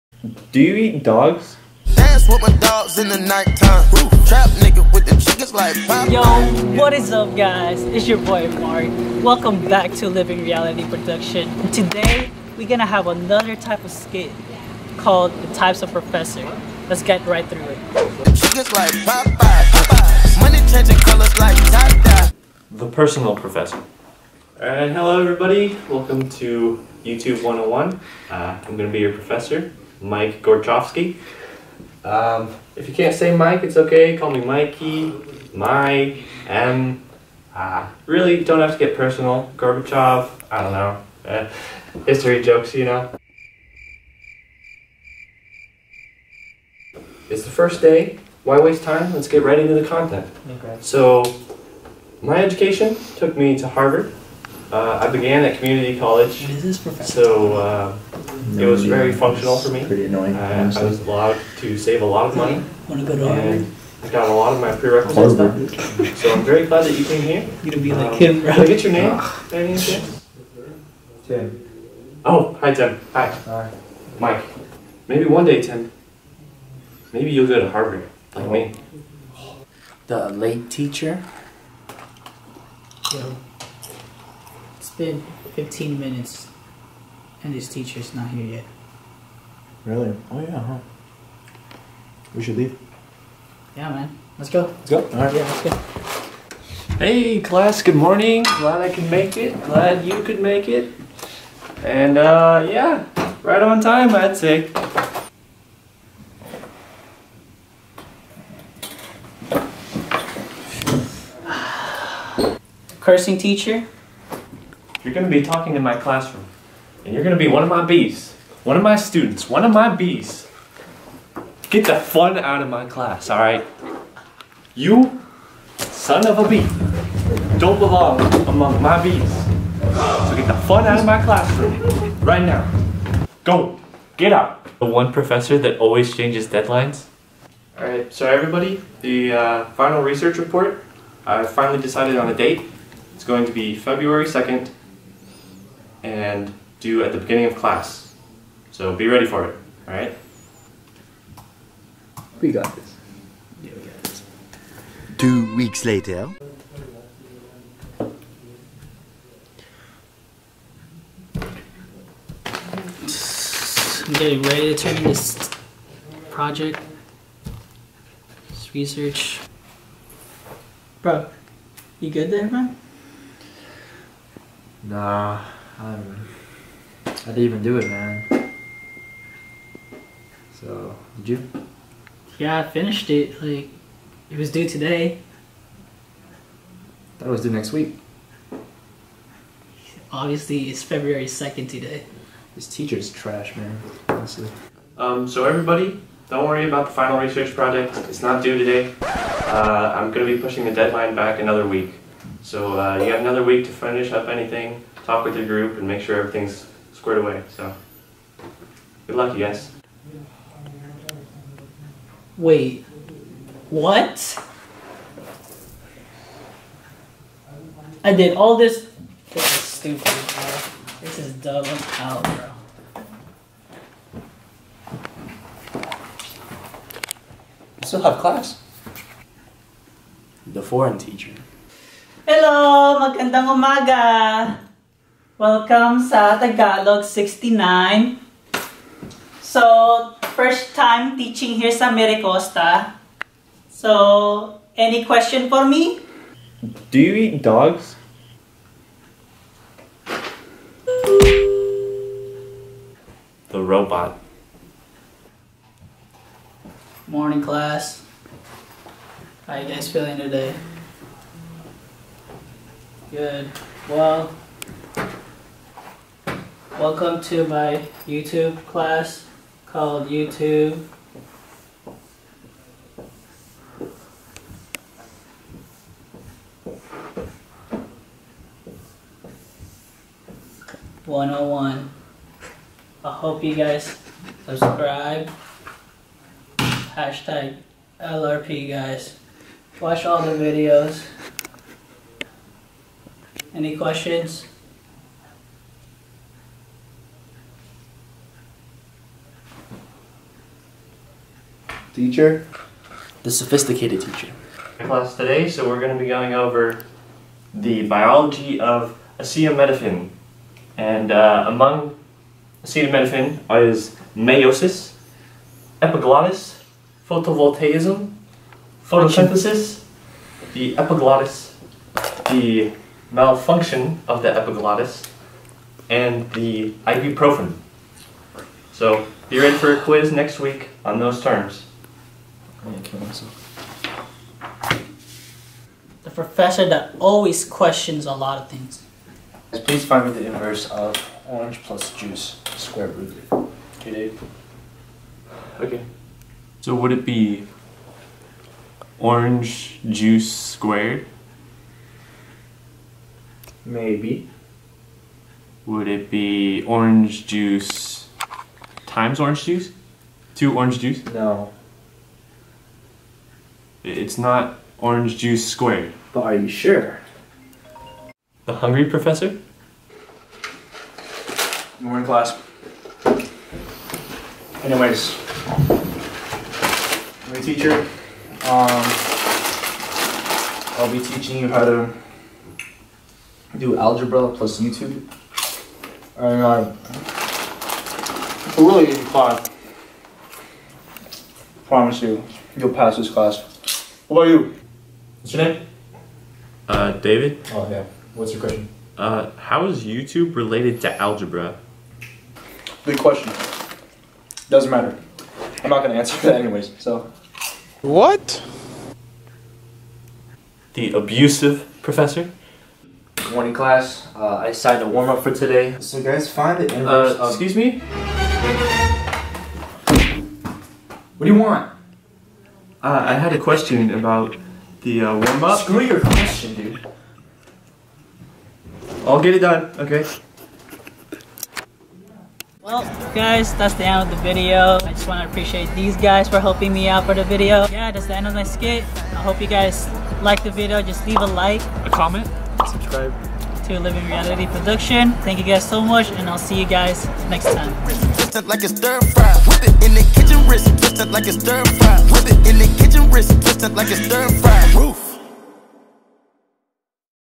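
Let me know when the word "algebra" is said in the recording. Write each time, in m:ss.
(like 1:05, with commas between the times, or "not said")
6:23, 6:41.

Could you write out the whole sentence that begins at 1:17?
Maybe you'll go to Harvard like me.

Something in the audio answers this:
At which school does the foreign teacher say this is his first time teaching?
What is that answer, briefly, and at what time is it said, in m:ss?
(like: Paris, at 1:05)
MiraCosta, at 4:01.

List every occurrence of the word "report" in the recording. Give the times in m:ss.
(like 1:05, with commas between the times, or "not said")
2:20.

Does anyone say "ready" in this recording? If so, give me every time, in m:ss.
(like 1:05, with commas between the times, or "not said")
2:29, 2:44, 5:29.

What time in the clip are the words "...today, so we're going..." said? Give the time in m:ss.
5:05.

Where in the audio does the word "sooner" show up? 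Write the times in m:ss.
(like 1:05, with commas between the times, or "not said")
not said.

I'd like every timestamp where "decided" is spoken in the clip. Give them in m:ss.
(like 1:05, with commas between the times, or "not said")
2:21, 6:54.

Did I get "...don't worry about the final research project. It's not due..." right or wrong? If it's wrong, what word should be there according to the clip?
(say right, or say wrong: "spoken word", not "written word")
right.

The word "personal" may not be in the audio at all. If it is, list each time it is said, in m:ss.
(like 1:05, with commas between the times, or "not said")
0:22, 0:38.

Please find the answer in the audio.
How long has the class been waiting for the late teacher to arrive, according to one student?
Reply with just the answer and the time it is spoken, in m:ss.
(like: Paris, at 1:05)
15 minutes, at 1:25.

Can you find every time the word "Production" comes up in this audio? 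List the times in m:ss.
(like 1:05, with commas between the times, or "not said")
0:10, 7:24.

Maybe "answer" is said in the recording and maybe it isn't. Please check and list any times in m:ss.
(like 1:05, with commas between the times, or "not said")
6:45.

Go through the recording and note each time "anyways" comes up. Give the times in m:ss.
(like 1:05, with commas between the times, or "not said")
6:14, 6:46.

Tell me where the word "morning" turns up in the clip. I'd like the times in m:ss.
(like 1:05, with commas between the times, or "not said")
1:37, 4:17, 6:53.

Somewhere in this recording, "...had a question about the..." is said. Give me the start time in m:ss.
7:03.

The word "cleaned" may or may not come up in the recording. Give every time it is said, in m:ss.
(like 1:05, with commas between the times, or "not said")
not said.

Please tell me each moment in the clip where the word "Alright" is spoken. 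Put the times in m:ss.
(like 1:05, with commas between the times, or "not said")
0:24.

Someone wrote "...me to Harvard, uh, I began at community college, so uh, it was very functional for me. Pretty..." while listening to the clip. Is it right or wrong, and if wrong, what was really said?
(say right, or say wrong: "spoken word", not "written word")
right.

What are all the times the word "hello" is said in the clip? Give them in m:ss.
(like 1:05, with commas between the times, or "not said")
0:24, 3:52.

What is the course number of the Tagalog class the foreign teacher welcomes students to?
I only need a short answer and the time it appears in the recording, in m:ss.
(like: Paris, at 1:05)
69, at 3:56.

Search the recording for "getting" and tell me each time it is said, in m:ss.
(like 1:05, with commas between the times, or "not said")
2:44.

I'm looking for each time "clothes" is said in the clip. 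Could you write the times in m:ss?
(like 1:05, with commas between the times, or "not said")
not said.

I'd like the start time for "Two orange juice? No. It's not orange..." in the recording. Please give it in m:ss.
6:00.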